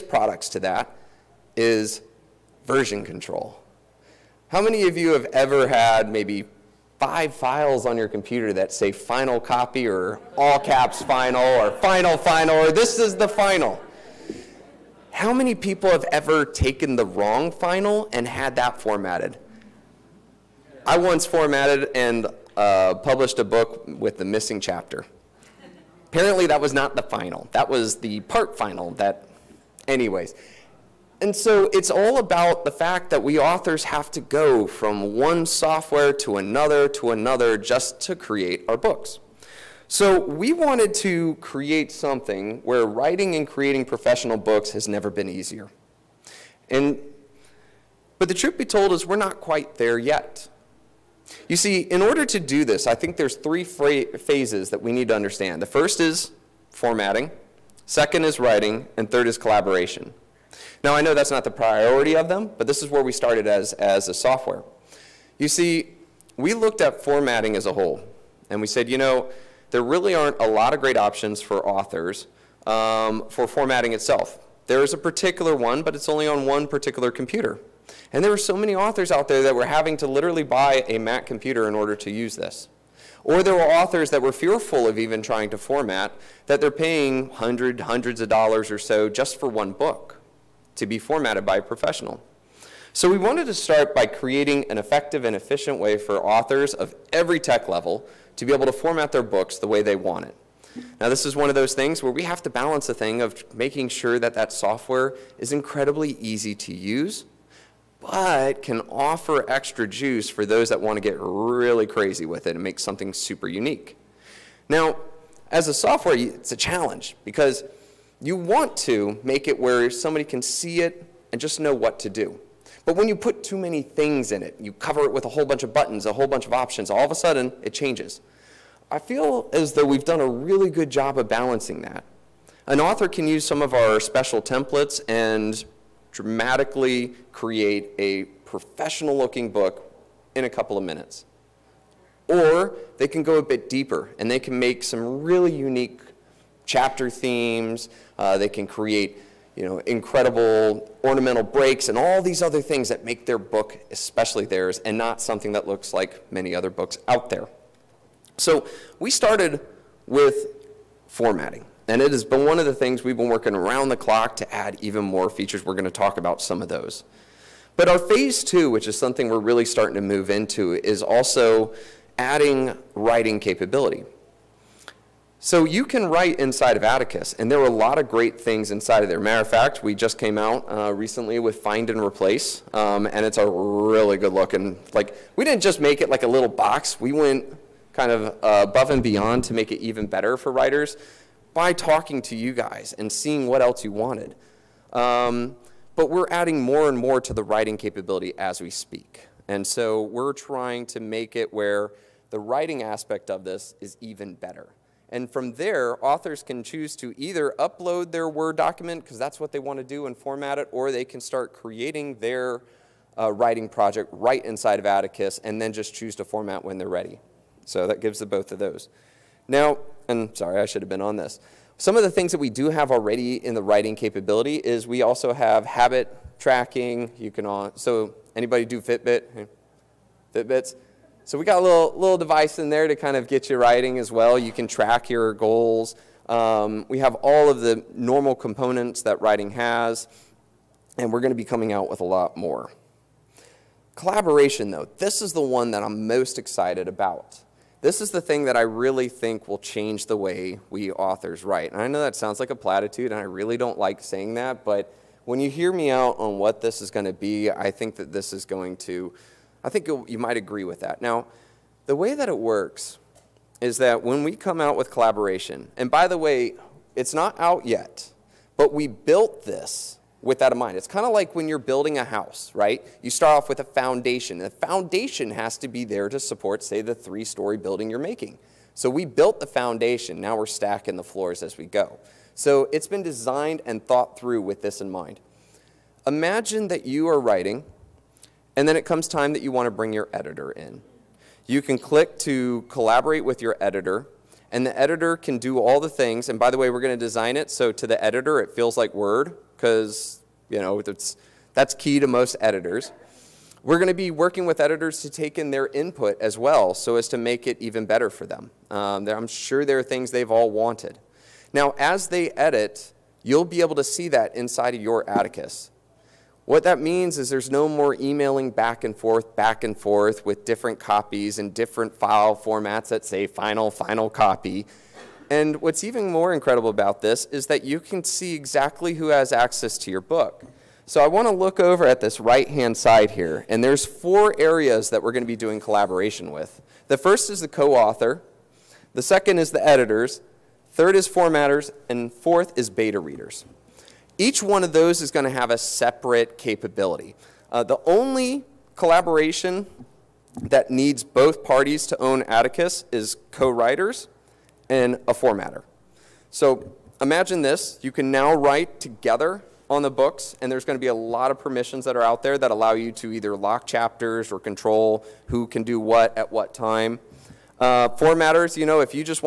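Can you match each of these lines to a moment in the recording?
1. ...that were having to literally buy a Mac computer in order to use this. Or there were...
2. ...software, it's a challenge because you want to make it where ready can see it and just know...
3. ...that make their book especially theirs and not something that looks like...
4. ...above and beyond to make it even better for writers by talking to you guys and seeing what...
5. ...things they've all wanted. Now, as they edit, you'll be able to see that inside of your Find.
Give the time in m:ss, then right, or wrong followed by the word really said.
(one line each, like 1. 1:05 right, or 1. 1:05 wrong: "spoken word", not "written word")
1. 1:19 right
2. 1:55 wrong: "somebody", not "ready"
3. 2:32 right
4. 3:08 right
5. 5:09 wrong: "Atticus", not "Find".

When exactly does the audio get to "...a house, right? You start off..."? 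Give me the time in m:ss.
4:31.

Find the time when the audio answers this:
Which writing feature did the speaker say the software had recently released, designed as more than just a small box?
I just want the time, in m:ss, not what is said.
3:01.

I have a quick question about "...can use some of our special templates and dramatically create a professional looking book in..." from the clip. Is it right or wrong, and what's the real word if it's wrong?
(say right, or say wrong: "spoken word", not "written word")
right.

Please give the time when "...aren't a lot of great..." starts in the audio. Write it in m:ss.
1:10.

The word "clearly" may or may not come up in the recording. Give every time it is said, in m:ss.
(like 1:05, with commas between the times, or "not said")
not said.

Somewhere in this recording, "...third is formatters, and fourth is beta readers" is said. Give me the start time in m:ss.
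5:40.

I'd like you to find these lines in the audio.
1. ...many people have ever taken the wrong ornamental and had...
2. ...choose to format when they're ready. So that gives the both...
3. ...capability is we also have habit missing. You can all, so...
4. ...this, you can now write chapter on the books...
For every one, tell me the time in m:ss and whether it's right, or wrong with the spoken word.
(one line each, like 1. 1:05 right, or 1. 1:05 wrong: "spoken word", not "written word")
1. 0:15 wrong: "final", not "ornamental"
2. 3:35 right
3. 3:43 wrong: "tracking", not "missing"
4. 5:57 wrong: "together", not "chapter".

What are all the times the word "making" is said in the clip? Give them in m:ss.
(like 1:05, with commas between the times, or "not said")
1:43, 4:37.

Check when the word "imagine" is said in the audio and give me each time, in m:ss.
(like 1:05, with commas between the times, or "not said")
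4:46, 5:56.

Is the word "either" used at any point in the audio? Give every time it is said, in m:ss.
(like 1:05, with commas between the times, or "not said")
3:27, 6:03.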